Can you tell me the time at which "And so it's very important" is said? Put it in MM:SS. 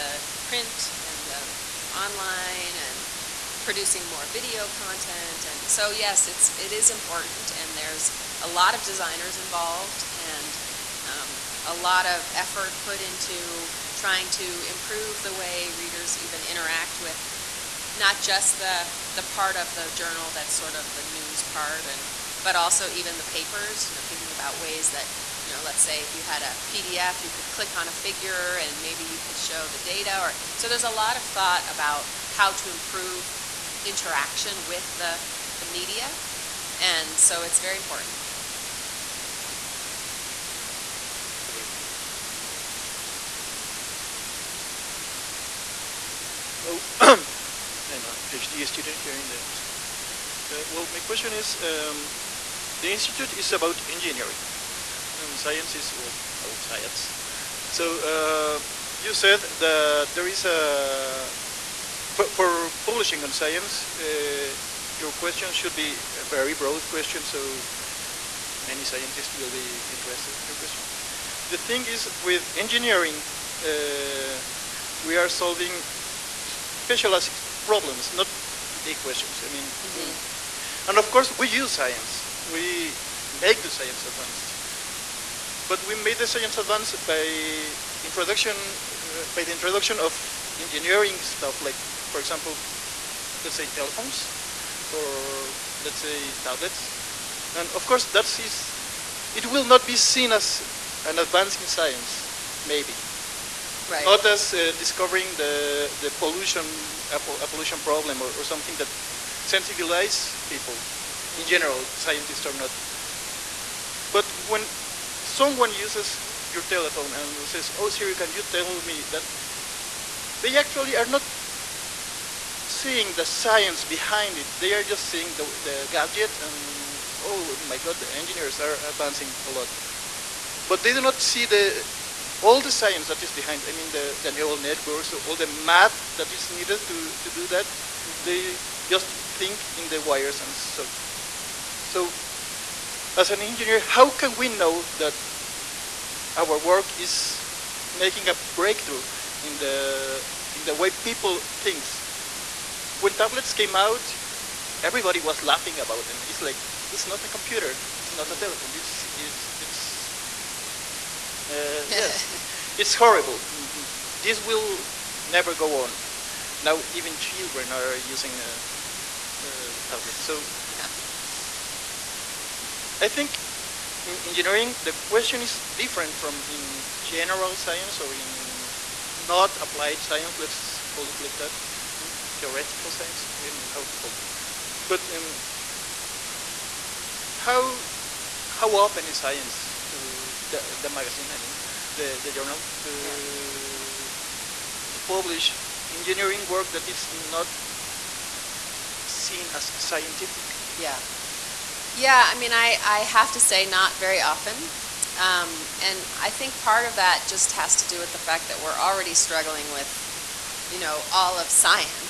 00:36.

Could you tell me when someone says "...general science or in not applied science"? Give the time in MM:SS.
02:57.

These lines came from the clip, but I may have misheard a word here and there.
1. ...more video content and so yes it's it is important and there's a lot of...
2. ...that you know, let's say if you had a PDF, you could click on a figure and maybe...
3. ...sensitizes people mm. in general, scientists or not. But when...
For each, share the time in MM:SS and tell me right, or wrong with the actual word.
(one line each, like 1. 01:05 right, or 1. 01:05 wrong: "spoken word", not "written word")
1. 00:04 right
2. 00:24 right
3. 01:49 right.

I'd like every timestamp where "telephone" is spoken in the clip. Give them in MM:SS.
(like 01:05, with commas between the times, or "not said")
01:33, 01:56, 02:38.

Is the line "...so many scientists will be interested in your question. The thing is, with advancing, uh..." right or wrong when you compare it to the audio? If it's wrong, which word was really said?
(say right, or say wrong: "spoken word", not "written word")
wrong: "engineering", not "advancing".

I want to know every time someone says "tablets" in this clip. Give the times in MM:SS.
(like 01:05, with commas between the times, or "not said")
01:36, 02:33, 02:49.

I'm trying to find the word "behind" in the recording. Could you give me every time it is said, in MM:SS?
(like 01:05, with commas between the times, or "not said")
02:03, 02:13.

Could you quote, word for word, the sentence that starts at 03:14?
to publish engineering work that is not seen as scientific.